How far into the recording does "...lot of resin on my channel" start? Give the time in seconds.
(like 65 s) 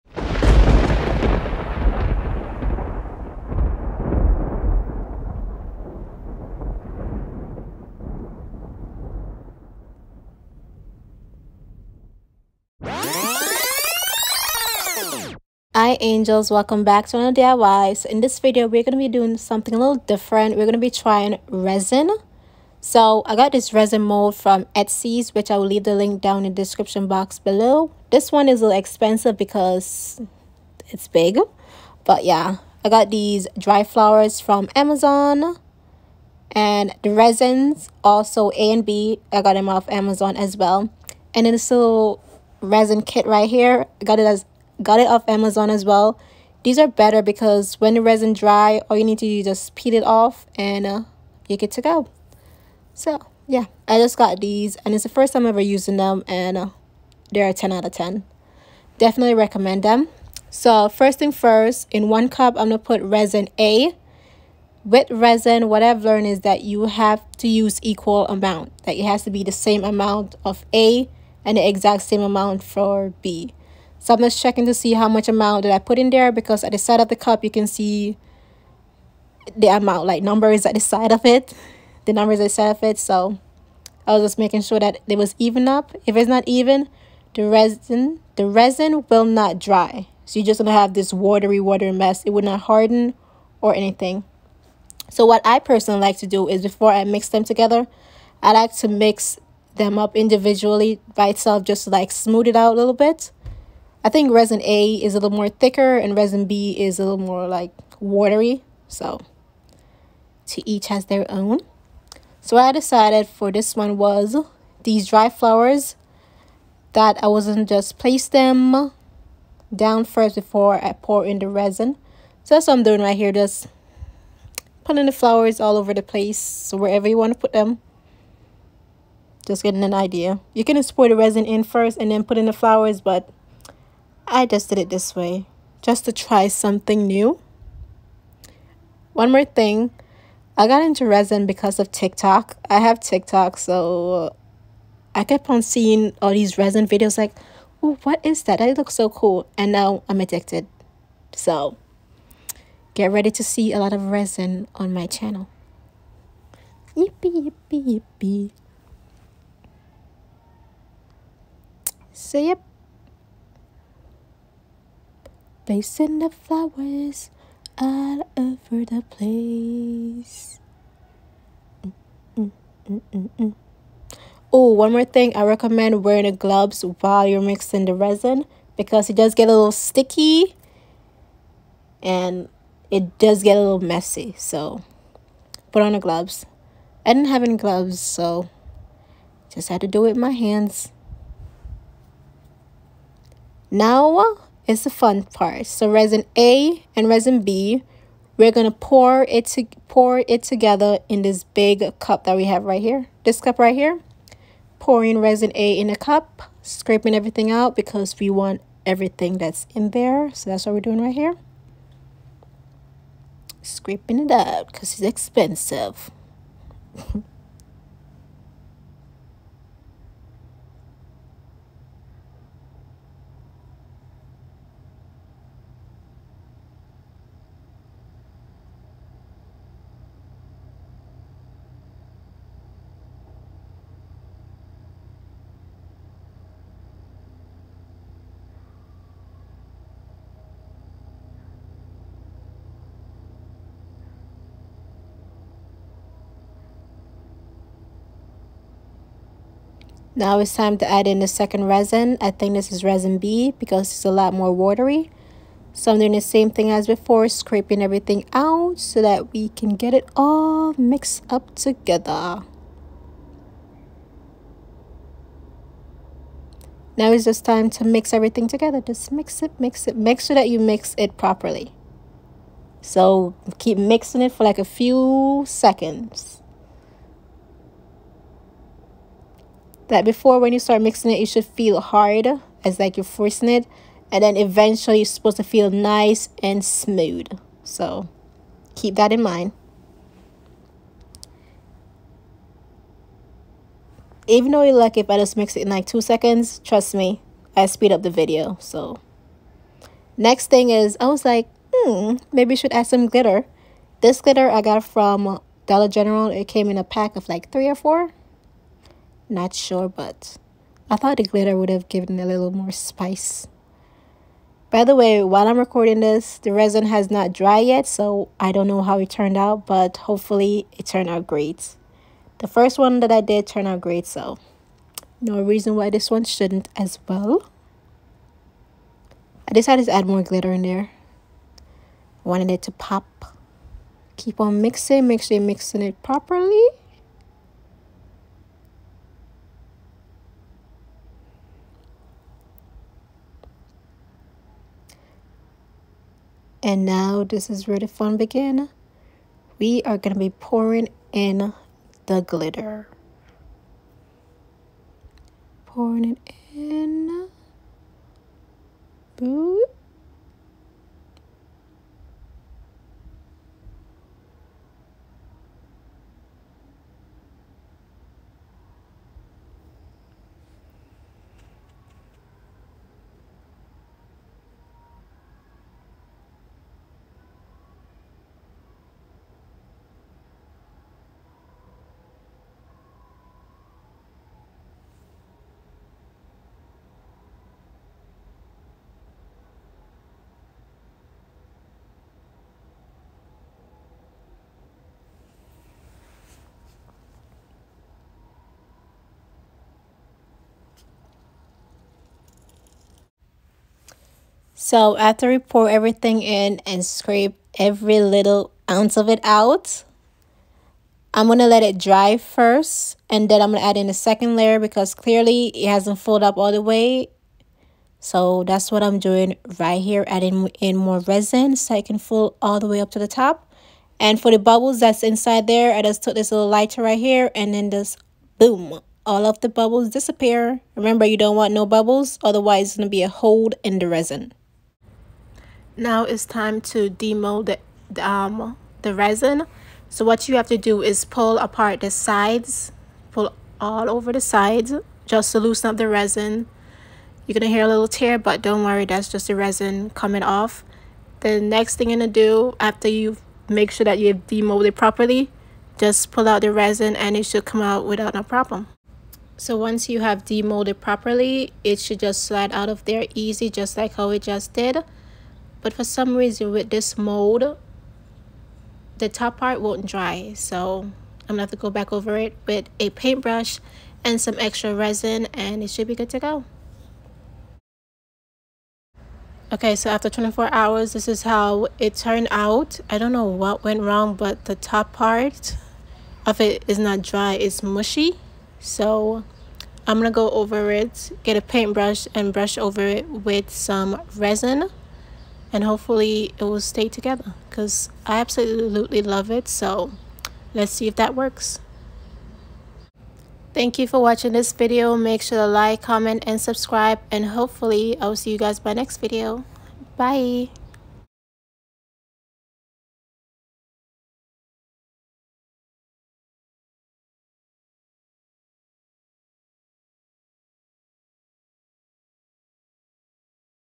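153 s.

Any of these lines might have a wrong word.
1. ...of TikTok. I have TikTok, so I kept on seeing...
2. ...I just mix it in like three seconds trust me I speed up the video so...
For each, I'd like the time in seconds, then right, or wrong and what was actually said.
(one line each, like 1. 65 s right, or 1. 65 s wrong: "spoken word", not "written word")
1. 141 s right
2. 295 s wrong: "two", not "three".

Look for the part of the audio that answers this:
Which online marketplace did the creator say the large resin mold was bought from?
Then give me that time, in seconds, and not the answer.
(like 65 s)
24 s.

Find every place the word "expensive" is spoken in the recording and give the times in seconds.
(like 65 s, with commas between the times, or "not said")
28 s, 215 s.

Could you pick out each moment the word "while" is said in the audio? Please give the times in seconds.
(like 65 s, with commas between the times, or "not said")
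176 s, 315 s.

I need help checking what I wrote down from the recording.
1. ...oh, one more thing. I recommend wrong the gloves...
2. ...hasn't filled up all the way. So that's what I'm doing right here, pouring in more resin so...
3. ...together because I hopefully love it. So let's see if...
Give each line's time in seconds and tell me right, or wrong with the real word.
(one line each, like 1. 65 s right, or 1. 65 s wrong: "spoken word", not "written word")
1. 174 s wrong: "wearing", not "wrong"
2. 415 s wrong: "adding", not "pouring"
3. 496 s wrong: "absolutely", not "hopefully".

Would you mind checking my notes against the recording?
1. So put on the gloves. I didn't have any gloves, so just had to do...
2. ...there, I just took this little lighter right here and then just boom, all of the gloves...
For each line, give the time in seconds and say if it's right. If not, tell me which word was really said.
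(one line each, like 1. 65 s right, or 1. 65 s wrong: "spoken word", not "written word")
1. 184 s right
2. 425 s wrong: "bubbles", not "gloves".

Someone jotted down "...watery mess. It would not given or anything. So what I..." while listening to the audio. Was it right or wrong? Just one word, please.
wrong.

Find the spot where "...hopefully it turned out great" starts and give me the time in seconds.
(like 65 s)
319 s.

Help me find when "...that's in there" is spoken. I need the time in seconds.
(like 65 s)
209 s.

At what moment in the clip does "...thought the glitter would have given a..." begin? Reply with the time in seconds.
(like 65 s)
310 s.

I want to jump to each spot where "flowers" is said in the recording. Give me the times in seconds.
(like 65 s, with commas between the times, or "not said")
33 s, 115 s, 125 s, 132 s, 166 s.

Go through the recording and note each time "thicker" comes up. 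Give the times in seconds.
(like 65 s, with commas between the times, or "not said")
105 s.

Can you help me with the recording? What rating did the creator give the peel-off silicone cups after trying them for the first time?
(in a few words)
10 out of 10.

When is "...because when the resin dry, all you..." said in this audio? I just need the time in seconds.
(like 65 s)
47 s.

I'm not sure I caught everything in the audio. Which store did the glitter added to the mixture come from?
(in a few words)
Dollar General.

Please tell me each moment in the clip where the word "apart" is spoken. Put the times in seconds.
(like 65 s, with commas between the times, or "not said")
441 s.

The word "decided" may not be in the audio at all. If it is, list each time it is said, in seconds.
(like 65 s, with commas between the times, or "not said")
112 s, 329 s.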